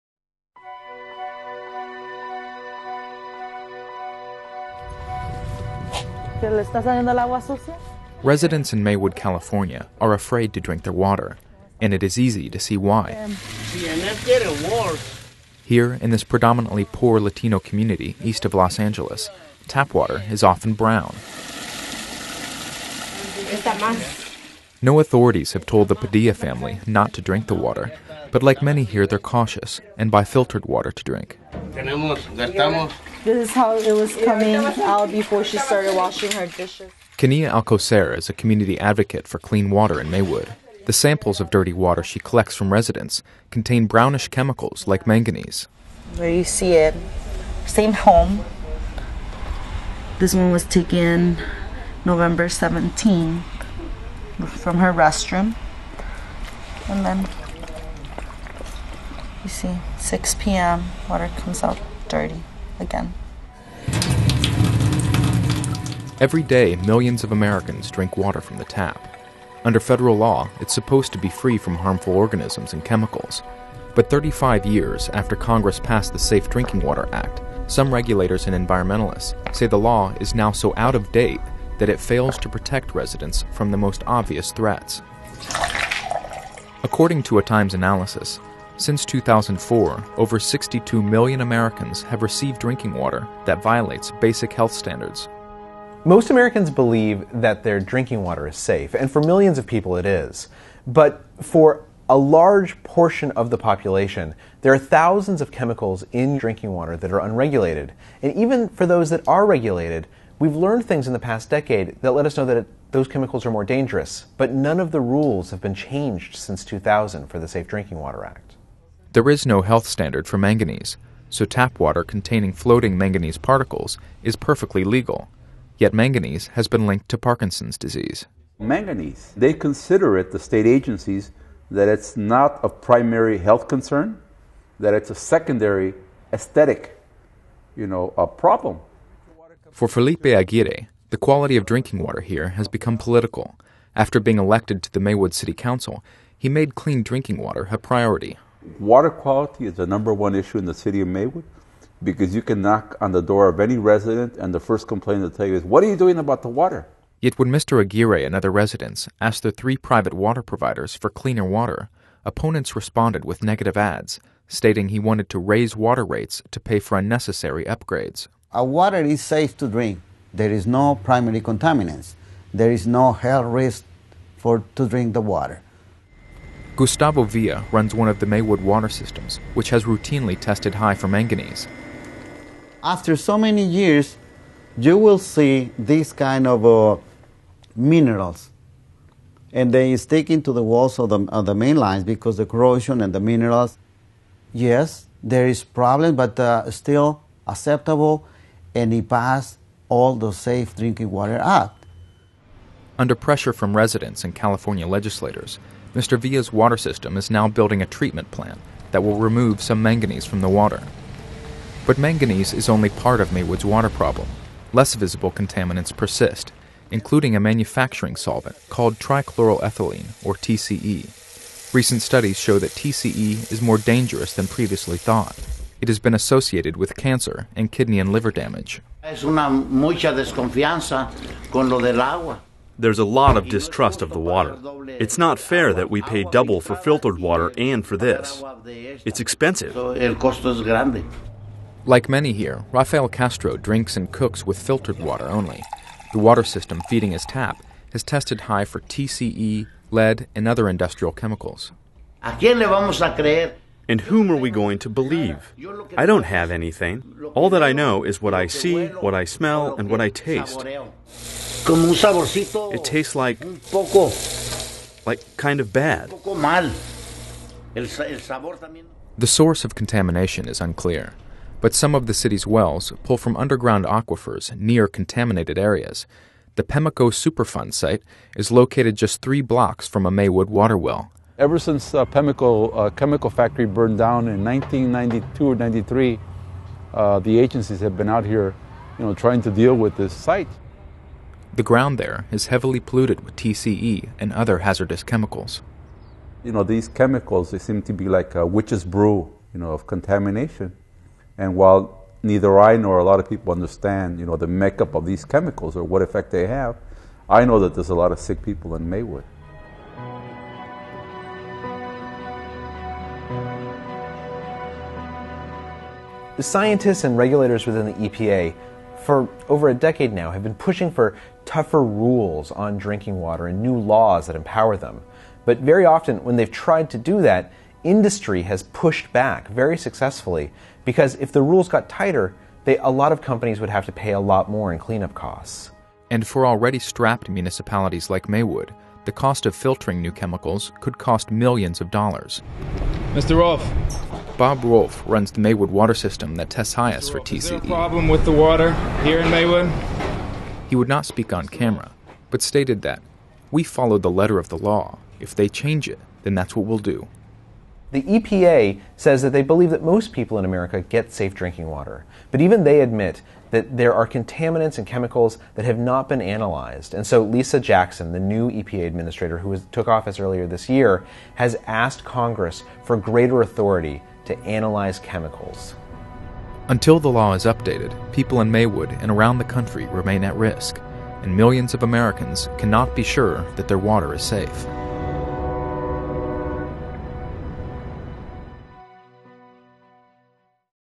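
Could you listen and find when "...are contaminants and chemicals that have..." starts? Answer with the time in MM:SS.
06:03.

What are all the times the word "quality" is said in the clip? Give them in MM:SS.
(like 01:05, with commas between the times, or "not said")
02:21, 02:29.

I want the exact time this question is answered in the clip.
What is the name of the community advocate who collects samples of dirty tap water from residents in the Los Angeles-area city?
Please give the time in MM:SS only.
00:37.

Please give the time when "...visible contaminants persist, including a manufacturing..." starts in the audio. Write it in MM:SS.
03:34.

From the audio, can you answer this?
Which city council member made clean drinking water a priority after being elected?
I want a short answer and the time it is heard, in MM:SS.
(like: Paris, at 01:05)
Felipe Aguirre, at 02:19.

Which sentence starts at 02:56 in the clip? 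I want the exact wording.
Gustavo Villa runs one of the Maywood water systems, which has routinely tested high for manganese.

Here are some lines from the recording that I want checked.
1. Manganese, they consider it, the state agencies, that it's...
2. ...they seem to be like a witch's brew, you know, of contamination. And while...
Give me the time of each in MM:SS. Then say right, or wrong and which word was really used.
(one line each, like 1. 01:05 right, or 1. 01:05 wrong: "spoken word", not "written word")
1. 02:08 right
2. 04:57 right.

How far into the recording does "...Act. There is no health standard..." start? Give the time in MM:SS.
01:58.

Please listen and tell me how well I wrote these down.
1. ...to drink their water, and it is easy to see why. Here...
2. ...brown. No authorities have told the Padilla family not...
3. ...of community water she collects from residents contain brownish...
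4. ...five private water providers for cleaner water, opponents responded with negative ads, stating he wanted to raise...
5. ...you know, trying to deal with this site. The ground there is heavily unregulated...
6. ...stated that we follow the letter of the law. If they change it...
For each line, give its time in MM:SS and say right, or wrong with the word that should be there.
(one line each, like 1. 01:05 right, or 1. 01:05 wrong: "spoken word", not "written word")
1. 00:10 right
2. 00:20 right
3. 00:41 wrong: "dirty", not "community"
4. 02:39 wrong: "three", not "five"
5. 04:48 wrong: "polluted", not "unregulated"
6. 05:52 right.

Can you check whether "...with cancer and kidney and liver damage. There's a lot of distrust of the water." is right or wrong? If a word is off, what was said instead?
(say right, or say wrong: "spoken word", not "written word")
right.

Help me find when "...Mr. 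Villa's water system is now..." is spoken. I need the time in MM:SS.
03:25.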